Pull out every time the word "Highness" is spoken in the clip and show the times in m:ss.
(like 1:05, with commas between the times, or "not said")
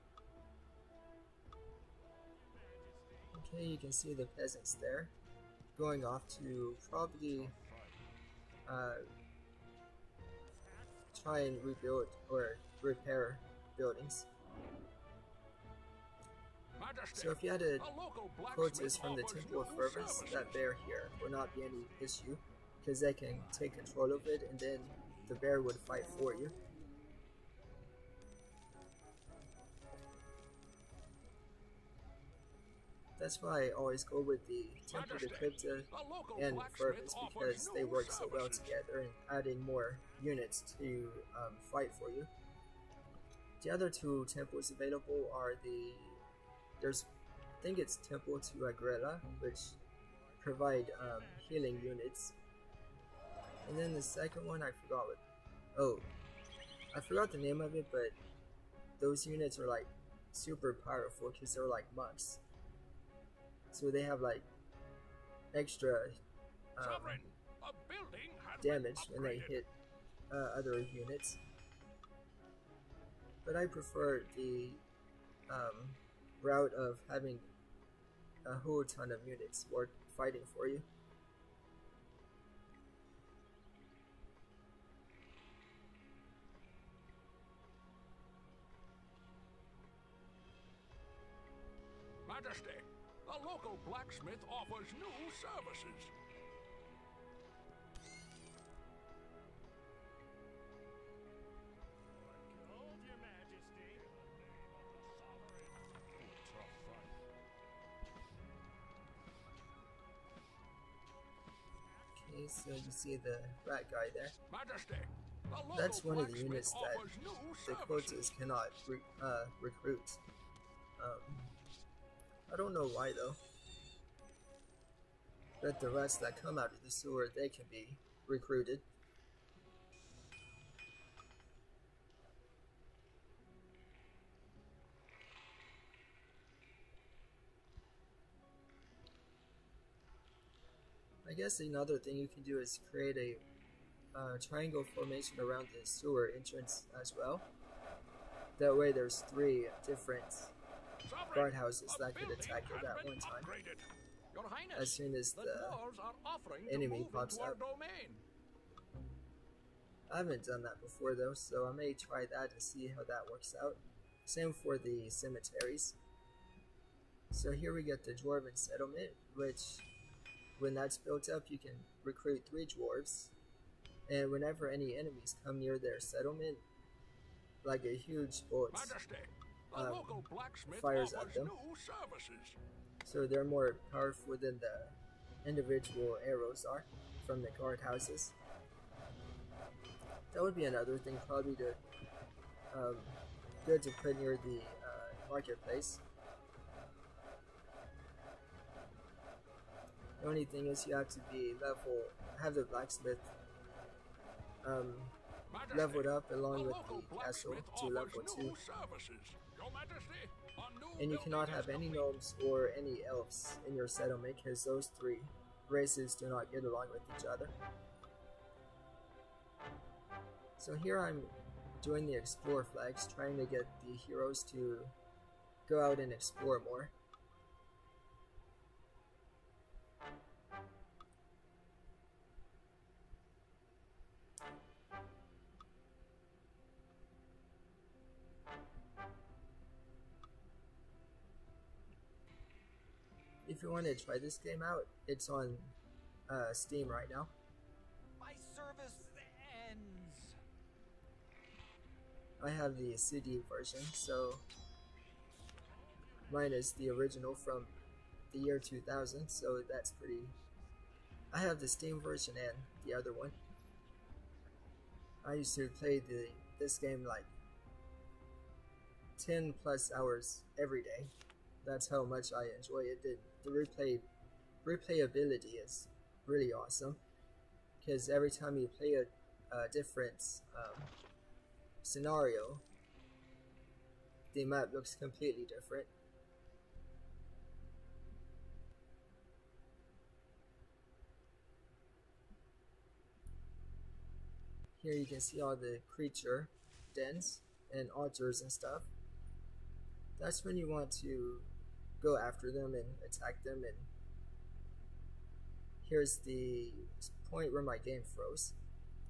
2:34.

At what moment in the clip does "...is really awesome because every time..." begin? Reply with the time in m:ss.
4:35.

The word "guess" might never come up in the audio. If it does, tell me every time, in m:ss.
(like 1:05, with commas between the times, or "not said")
2:21.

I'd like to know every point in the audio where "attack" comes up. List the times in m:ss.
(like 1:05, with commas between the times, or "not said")
2:32, 5:03.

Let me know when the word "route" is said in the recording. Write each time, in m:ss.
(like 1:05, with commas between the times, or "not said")
1:16.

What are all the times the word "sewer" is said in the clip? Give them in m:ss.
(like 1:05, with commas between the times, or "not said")
2:06, 2:25.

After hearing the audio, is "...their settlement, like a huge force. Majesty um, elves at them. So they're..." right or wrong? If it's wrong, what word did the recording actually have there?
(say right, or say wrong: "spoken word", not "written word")
wrong: "fires", not "elves".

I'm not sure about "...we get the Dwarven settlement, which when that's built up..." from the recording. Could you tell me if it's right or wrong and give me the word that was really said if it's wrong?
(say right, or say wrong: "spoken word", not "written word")
right.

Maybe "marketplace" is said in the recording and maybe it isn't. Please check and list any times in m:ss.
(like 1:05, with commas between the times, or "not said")
3:15.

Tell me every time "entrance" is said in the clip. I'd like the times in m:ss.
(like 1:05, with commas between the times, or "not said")
2:26.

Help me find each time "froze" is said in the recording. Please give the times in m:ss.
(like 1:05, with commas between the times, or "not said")
5:08.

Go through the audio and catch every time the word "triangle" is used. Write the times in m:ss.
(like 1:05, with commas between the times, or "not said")
2:24.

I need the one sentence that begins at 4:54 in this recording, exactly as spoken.
Here you can see all the creature dens and altars and stuff.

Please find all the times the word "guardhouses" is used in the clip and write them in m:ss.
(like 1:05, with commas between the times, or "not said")
2:31, 3:07.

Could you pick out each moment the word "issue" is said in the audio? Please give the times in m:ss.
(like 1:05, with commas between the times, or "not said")
0:22.